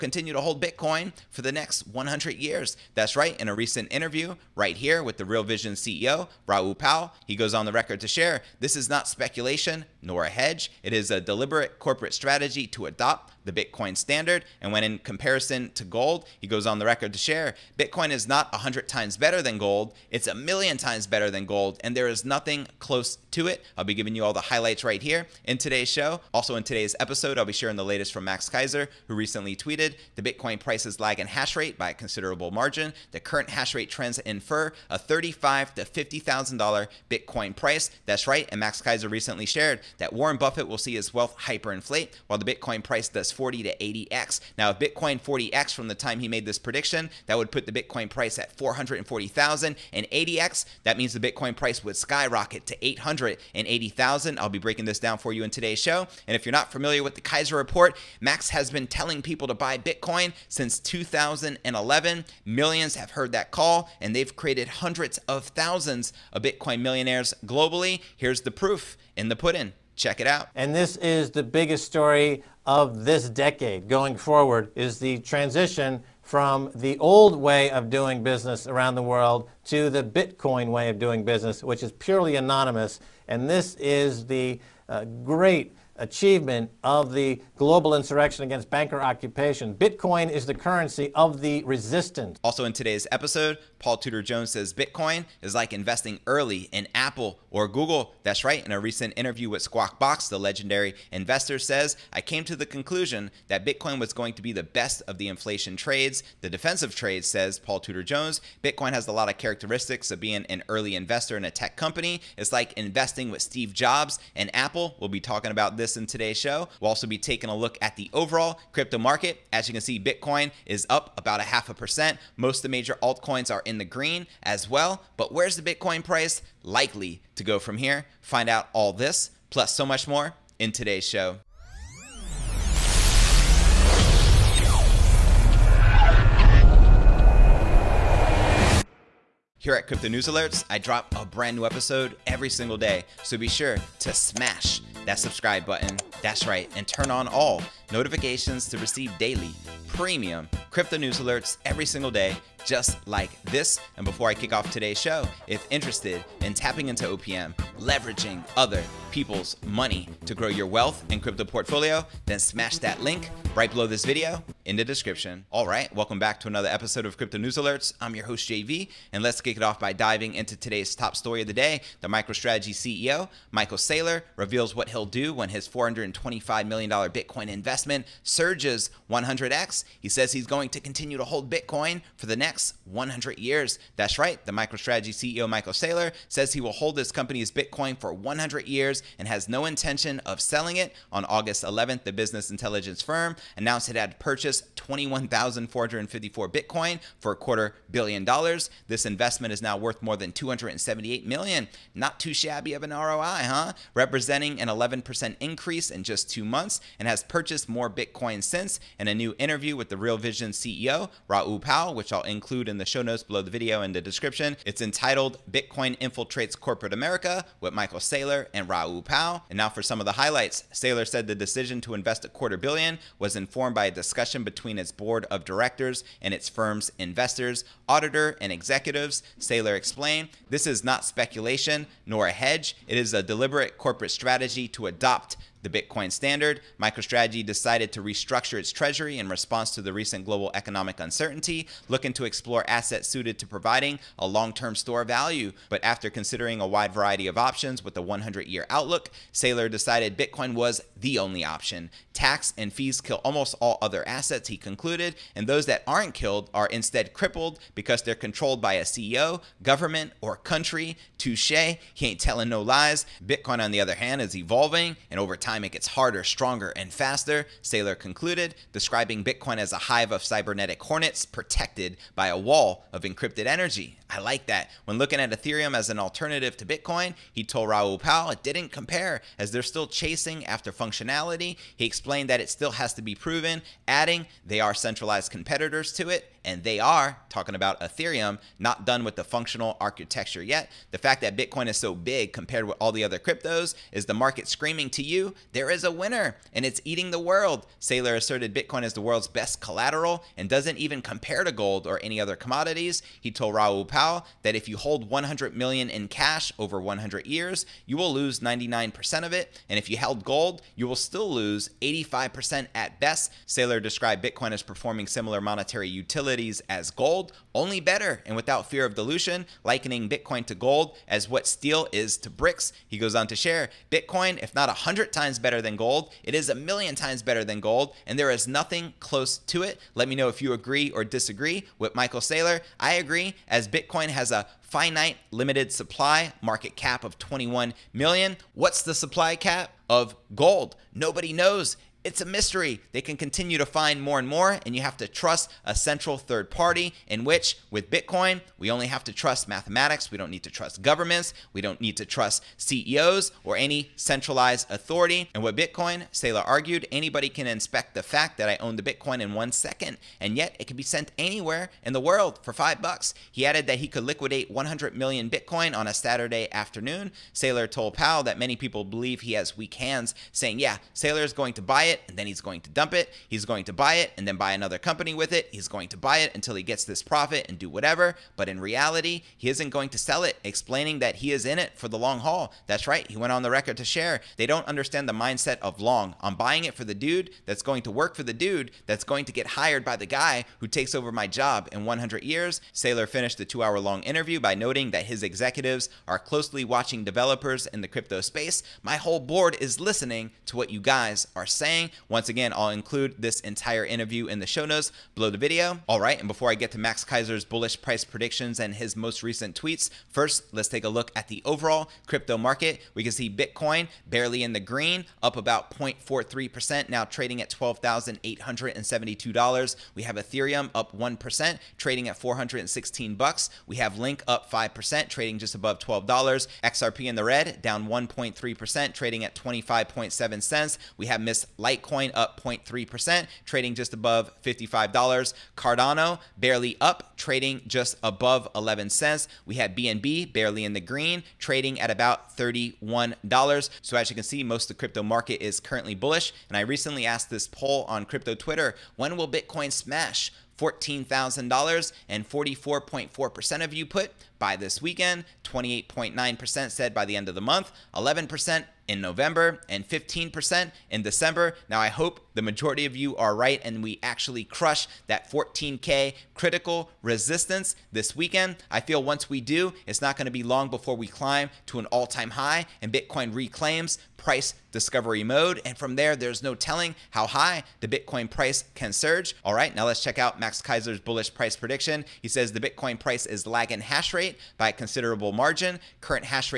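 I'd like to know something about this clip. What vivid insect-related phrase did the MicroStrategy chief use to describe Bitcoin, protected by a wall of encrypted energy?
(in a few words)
hive of cybernetic hornets.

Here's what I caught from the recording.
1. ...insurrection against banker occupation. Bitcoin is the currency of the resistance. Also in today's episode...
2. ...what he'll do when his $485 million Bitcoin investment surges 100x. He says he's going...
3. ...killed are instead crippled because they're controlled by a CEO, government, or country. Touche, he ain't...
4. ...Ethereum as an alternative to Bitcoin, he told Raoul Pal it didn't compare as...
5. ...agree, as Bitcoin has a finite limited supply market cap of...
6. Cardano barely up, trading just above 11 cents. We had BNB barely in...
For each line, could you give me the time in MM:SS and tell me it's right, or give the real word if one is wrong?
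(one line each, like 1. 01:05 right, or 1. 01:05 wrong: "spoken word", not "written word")
1. 01:27 right
2. 02:54 wrong: "425", not "485"
3. 04:16 right
4. 04:35 right
5. 05:32 right
6. 07:15 right.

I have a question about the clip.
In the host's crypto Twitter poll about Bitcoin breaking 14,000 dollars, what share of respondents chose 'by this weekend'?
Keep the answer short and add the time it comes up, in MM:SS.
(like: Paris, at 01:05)
44.4%, at 07:32.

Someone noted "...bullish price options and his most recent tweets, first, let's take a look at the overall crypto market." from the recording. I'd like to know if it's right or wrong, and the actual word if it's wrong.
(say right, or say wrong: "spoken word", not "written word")
wrong: "predictions", not "options".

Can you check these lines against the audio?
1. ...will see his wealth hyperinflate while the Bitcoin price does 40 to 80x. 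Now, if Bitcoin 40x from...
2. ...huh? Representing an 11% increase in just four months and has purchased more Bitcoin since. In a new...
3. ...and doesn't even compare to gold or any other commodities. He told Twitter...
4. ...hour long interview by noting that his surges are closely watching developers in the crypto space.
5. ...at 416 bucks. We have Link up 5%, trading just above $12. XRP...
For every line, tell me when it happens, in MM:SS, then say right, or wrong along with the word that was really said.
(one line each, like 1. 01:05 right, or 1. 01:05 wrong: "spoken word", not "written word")
1. 00:40 right
2. 03:23 wrong: "two", not "four"
3. 05:00 wrong: "Raoul", not "Twitter"
4. 06:33 wrong: "executives", not "surges"
5. 07:02 right.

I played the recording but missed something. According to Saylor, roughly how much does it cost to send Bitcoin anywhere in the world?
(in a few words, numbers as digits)
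$5.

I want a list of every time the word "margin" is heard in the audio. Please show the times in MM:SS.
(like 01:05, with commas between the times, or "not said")
00:32, 08:05.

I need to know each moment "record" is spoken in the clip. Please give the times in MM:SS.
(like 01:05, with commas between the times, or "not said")
00:07, 00:16, 06:23.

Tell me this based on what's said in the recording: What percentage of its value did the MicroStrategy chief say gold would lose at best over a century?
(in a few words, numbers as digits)
85%.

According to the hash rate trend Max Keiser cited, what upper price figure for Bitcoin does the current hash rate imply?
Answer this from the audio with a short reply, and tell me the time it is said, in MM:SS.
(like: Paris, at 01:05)
$50,000, at 00:34.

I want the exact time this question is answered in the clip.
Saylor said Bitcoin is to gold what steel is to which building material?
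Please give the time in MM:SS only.
05:22.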